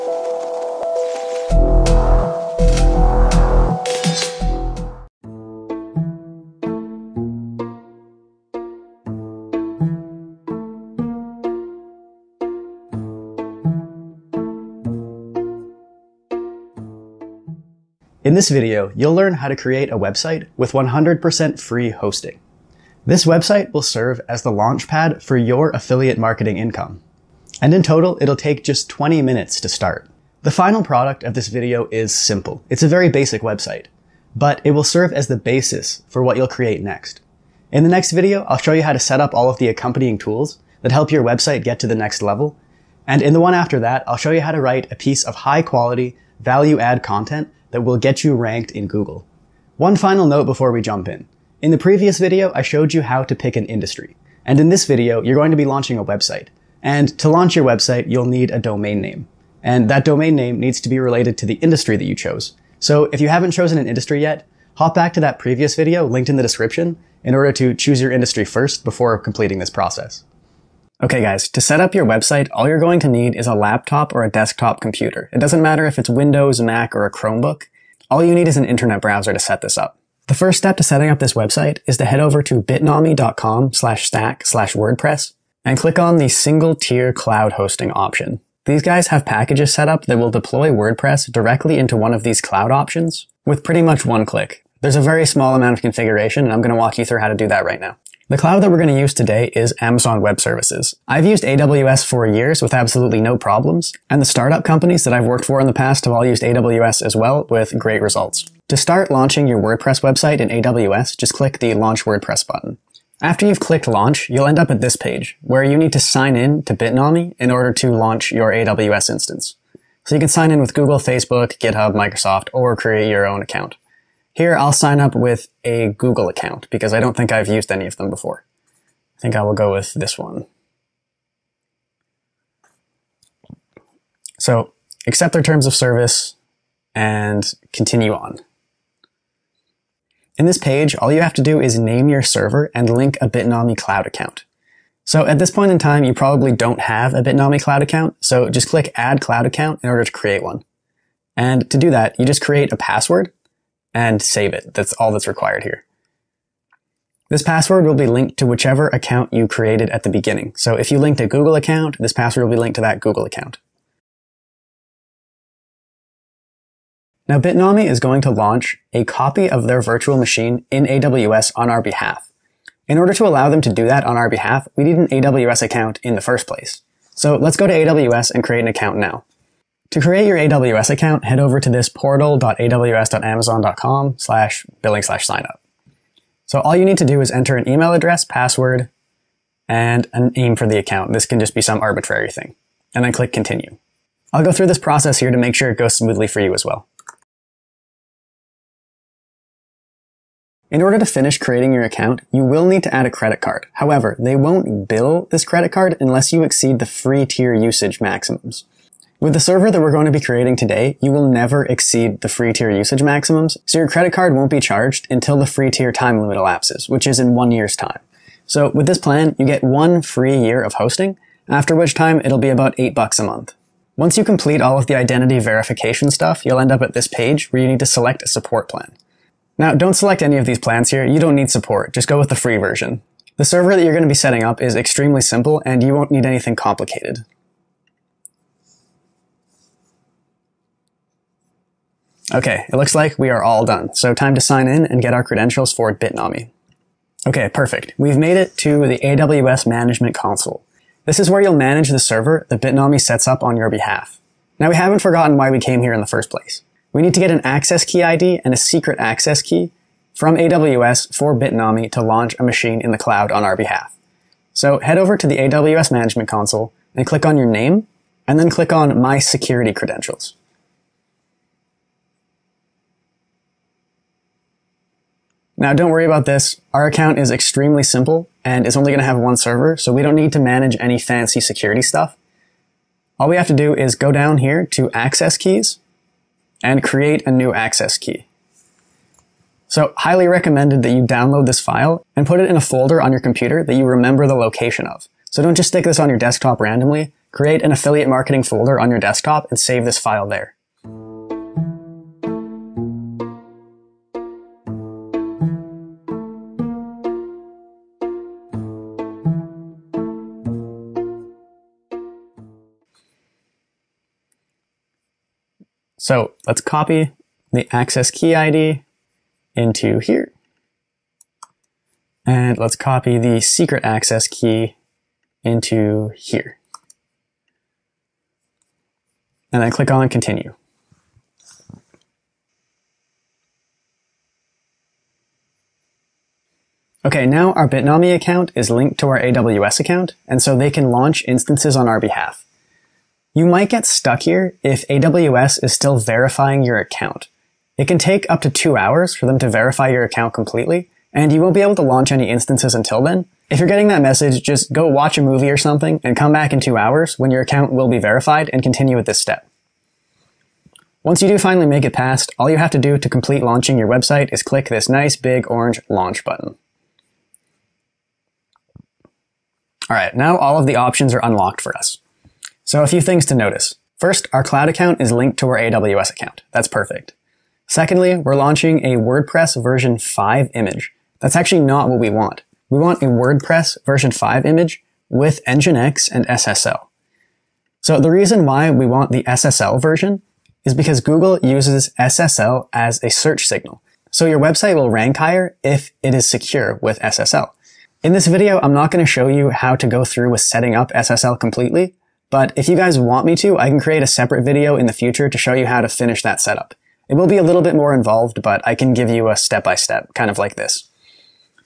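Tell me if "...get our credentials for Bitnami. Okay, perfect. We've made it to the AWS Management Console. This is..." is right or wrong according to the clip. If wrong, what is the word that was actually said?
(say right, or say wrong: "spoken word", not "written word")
right.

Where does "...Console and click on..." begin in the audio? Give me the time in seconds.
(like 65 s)
266 s.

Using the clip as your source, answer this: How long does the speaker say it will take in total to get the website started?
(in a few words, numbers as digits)
20 minutes.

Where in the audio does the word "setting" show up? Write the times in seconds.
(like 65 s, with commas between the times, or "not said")
80 s, 234 s, 400 s.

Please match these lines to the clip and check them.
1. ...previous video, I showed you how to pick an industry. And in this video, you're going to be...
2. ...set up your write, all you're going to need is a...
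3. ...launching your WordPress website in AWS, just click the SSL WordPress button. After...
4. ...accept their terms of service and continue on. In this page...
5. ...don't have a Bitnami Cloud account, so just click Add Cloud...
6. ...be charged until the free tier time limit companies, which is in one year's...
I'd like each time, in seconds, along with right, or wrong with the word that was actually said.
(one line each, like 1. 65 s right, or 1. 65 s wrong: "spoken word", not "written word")
1. 51 s right
2. 71 s wrong: "website", not "write"
3. 109 s wrong: "Launch", not "SSL"
4. 135 s right
5. 146 s right
6. 214 s wrong: "elapses", not "companies".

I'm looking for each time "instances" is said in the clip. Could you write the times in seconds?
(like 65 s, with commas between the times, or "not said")
119 s, 341 s, 352 s.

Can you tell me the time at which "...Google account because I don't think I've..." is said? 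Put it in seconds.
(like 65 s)
125 s.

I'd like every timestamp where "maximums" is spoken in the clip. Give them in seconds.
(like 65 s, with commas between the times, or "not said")
207 s, 213 s.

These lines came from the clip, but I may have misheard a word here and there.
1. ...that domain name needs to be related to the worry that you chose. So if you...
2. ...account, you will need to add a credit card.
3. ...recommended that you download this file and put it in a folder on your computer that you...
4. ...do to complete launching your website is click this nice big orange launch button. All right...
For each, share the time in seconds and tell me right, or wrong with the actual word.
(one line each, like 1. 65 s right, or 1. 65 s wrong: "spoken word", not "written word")
1. 59 s wrong: "industry", not "worry"
2. 201 s right
3. 290 s right
4. 362 s right.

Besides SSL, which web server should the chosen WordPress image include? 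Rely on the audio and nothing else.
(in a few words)
Nginx.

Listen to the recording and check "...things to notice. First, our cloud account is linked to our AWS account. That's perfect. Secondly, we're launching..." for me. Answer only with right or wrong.
right.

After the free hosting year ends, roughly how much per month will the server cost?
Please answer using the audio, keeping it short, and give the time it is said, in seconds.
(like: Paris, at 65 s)
$8, at 222 s.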